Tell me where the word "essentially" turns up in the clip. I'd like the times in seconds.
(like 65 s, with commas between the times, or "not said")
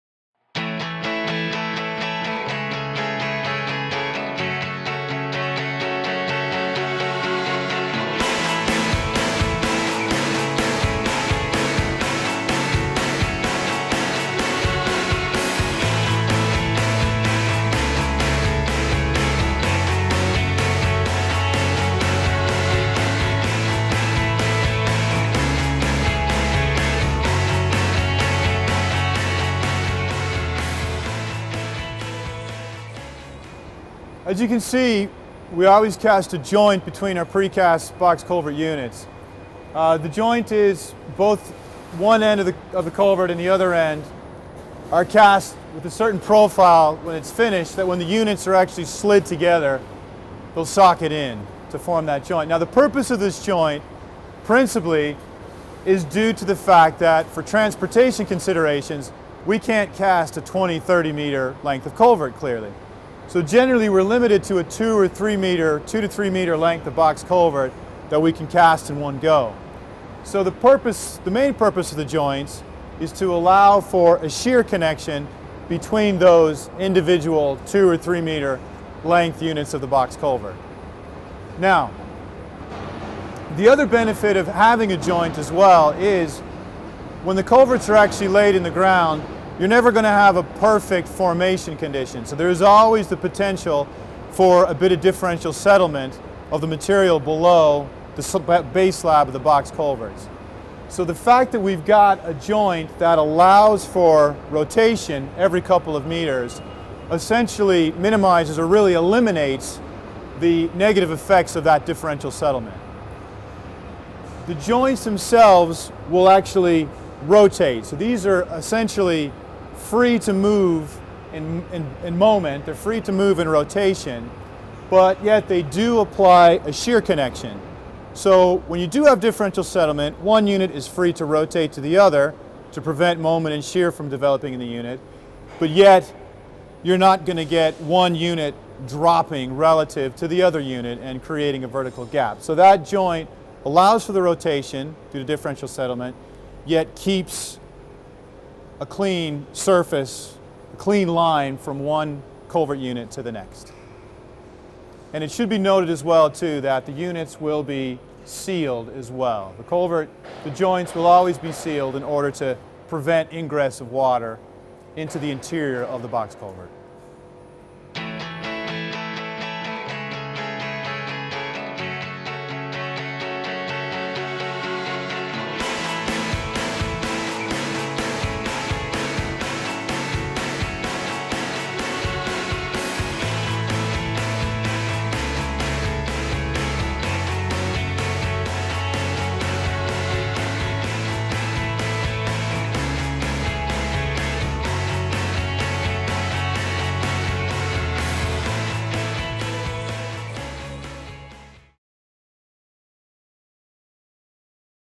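107 s, 118 s.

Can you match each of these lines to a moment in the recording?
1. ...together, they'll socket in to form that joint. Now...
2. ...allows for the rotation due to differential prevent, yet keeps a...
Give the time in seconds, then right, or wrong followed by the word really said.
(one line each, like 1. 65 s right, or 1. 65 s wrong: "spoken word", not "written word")
1. 49 s right
2. 143 s wrong: "settlement", not "prevent".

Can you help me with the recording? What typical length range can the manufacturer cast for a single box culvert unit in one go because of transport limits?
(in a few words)
2 to 3 meters.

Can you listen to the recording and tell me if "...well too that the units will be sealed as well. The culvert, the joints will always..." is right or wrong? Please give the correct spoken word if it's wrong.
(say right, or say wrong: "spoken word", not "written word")
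right.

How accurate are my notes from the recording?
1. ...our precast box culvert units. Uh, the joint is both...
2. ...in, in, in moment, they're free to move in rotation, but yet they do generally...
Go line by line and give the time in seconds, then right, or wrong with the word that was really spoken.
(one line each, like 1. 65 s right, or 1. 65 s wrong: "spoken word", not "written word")
1. 37 s right
2. 121 s wrong: "apply", not "generally".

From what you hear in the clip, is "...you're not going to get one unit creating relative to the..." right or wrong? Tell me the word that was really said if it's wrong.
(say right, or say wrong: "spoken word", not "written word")
wrong: "dropping", not "creating".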